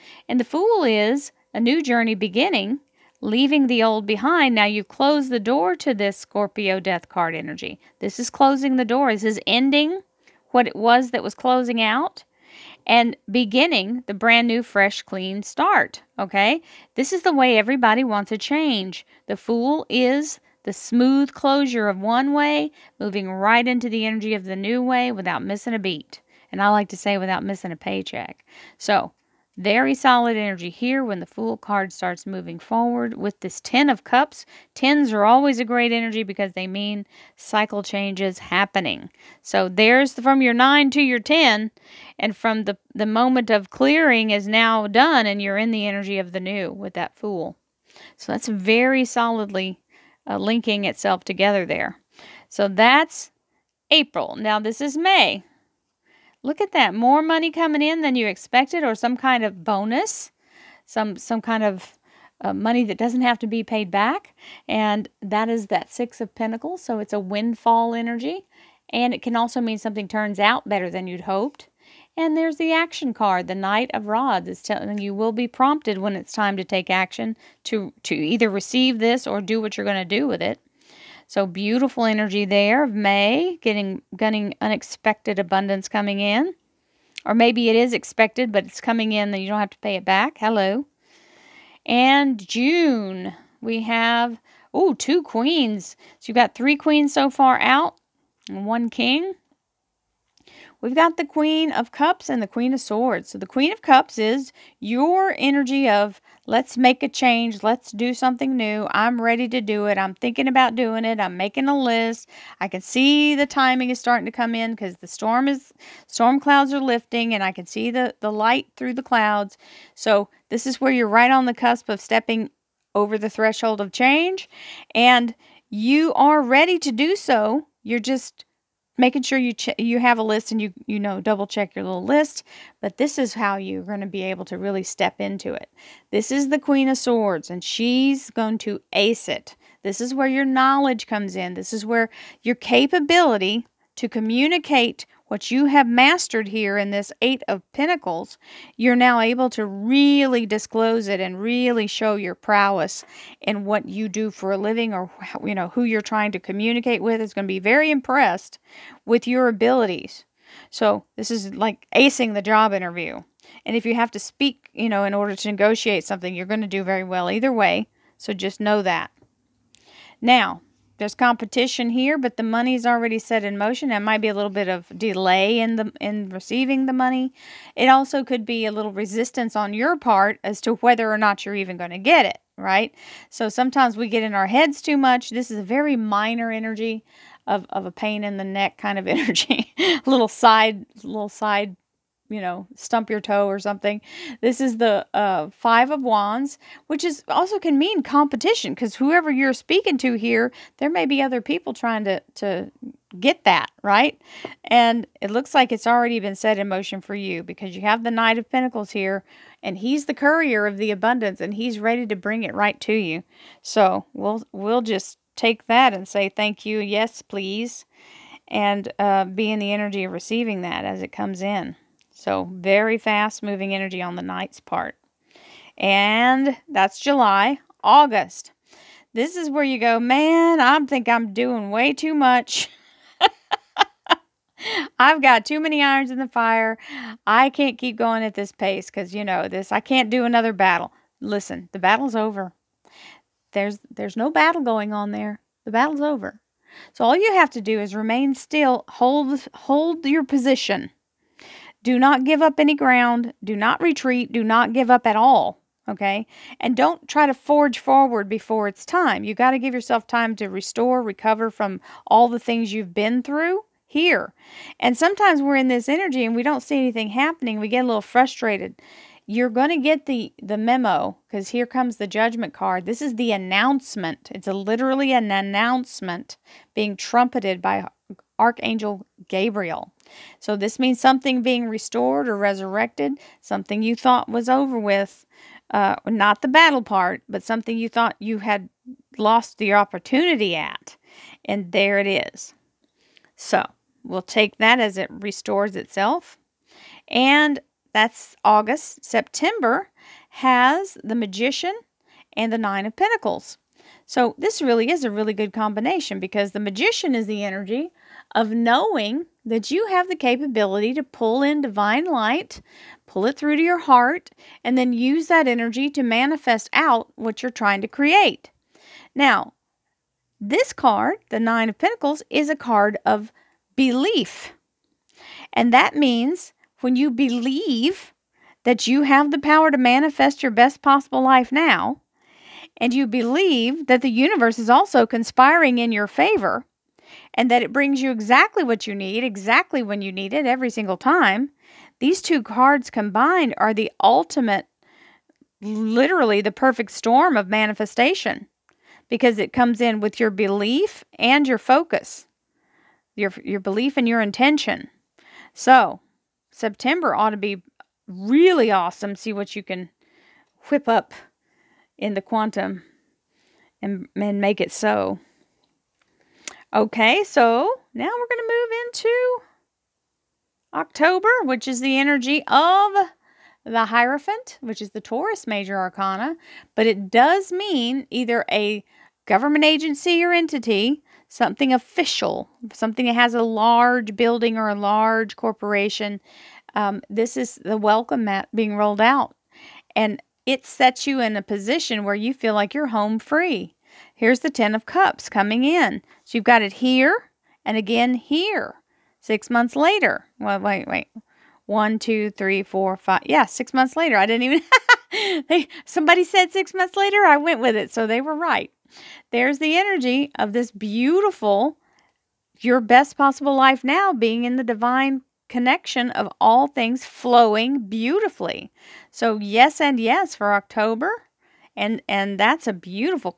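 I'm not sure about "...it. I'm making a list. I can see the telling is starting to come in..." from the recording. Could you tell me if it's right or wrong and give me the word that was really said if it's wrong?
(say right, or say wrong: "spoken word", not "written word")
wrong: "timing", not "telling".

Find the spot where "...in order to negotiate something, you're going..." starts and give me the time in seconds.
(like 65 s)
165 s.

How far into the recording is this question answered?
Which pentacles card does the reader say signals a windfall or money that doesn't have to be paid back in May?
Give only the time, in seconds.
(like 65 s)
65 s.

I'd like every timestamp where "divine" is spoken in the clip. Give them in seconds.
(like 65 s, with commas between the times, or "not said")
311 s, 414 s.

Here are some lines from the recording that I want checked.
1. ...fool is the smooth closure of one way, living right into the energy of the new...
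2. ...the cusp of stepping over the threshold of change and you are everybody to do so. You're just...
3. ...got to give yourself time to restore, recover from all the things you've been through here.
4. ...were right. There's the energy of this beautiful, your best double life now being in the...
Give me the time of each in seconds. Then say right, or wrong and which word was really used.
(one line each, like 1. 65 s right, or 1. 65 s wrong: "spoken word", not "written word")
1. 19 s wrong: "moving", not "living"
2. 121 s wrong: "ready", not "everybody"
3. 259 s right
4. 408 s wrong: "possible", not "double".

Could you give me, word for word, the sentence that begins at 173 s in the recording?
It might be a little bit of delay in the in receiving the money.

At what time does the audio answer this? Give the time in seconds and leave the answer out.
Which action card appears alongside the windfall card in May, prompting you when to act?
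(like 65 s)
73 s.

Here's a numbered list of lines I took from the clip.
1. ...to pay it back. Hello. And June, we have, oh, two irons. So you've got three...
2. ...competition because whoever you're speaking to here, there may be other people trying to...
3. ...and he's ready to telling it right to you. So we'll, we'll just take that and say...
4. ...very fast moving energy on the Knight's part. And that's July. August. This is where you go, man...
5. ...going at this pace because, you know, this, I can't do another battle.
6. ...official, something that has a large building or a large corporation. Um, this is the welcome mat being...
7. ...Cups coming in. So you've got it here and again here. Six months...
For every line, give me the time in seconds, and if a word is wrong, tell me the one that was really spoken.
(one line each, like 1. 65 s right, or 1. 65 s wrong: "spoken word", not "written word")
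1. 89 s wrong: "queens", not "irons"
2. 198 s right
3. 211 s wrong: "bring", not "telling"
4. 222 s right
5. 237 s right
6. 381 s right
7. 394 s right.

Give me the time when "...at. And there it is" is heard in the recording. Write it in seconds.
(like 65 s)
290 s.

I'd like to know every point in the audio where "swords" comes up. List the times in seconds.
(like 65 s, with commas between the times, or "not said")
102 s, 136 s.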